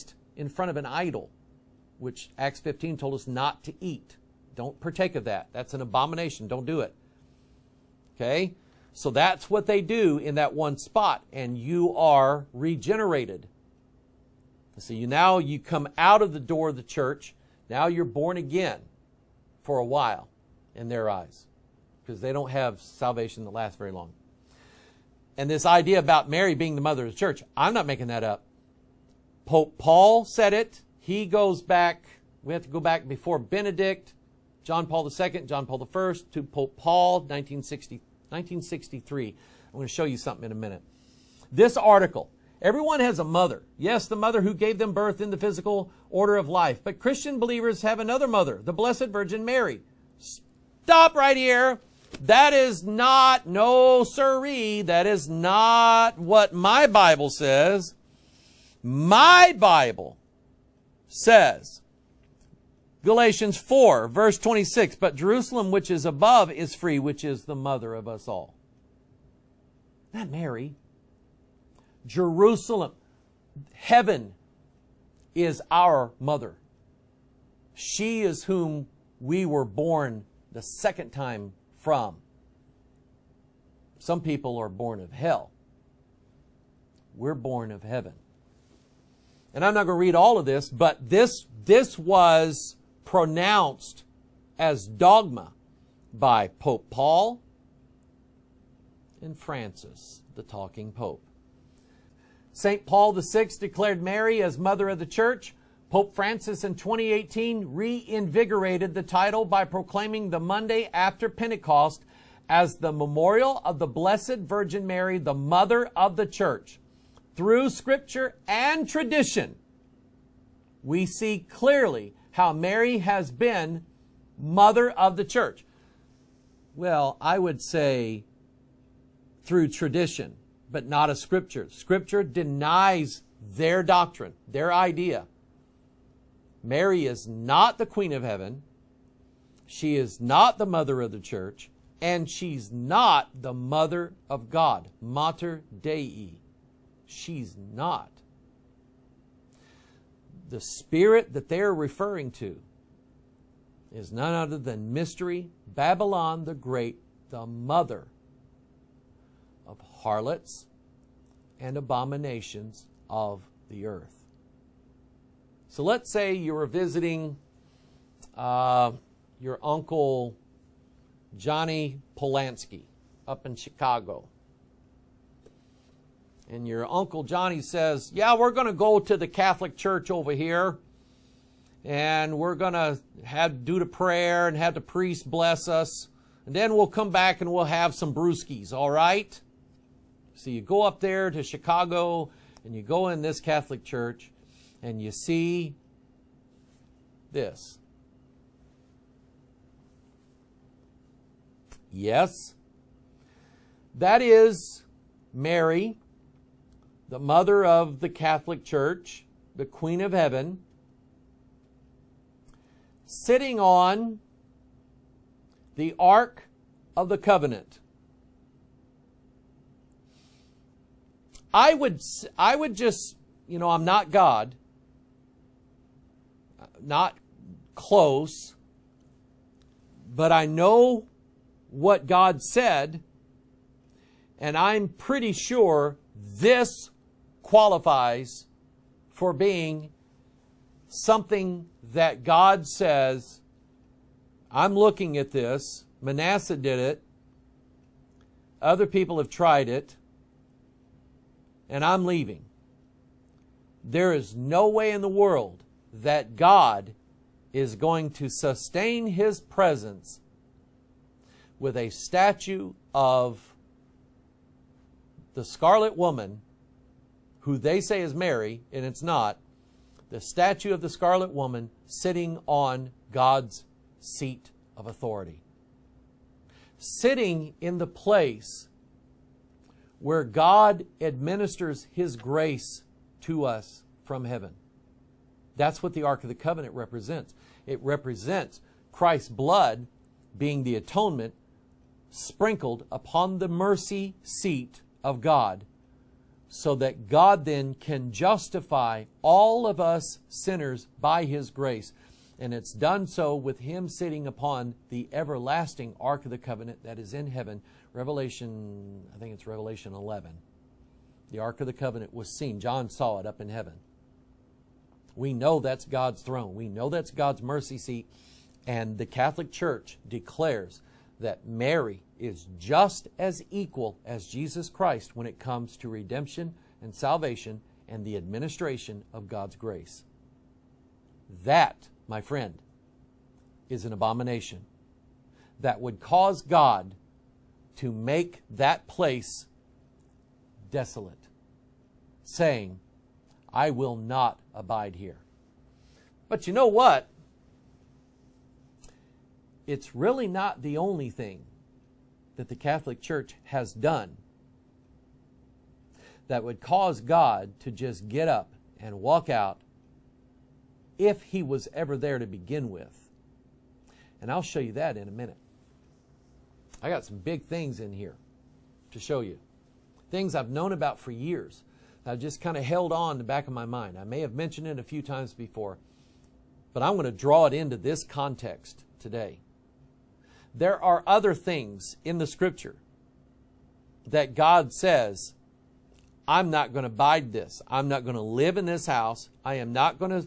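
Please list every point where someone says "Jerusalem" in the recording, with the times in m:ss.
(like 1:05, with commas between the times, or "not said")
1:05, 1:12.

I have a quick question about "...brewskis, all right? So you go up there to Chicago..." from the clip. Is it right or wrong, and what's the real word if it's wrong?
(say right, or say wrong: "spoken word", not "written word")
right.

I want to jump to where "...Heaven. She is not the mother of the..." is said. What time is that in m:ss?
2:18.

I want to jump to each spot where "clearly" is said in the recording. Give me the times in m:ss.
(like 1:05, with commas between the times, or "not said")
2:01.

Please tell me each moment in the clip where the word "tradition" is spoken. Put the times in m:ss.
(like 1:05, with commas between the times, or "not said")
1:58, 2:09.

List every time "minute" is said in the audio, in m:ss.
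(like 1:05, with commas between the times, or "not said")
0:40, 6:05.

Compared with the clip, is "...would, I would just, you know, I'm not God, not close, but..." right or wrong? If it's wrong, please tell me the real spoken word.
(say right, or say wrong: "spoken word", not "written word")
right.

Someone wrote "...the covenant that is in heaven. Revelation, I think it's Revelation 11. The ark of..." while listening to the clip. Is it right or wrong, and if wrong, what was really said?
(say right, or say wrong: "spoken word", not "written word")
right.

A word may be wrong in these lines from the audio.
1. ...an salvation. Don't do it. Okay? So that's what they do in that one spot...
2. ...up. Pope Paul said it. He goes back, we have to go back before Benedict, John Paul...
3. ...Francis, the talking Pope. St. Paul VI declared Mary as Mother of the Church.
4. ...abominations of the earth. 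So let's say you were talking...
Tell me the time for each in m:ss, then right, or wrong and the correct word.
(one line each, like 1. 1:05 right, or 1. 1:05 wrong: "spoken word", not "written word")
1. 0:05 wrong: "abomination", not "salvation"
2. 0:28 right
3. 1:39 right
4. 2:41 wrong: "visiting", not "talking".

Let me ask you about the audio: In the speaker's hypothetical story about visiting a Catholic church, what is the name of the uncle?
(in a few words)
Johnny Polanski.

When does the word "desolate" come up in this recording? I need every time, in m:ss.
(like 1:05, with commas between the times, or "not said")
5:40.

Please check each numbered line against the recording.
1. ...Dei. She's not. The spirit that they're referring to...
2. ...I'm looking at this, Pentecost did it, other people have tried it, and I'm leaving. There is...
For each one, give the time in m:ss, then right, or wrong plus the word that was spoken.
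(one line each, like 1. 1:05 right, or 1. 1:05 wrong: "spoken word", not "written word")
1. 2:25 right
2. 4:04 wrong: "Manasseh", not "Pentecost".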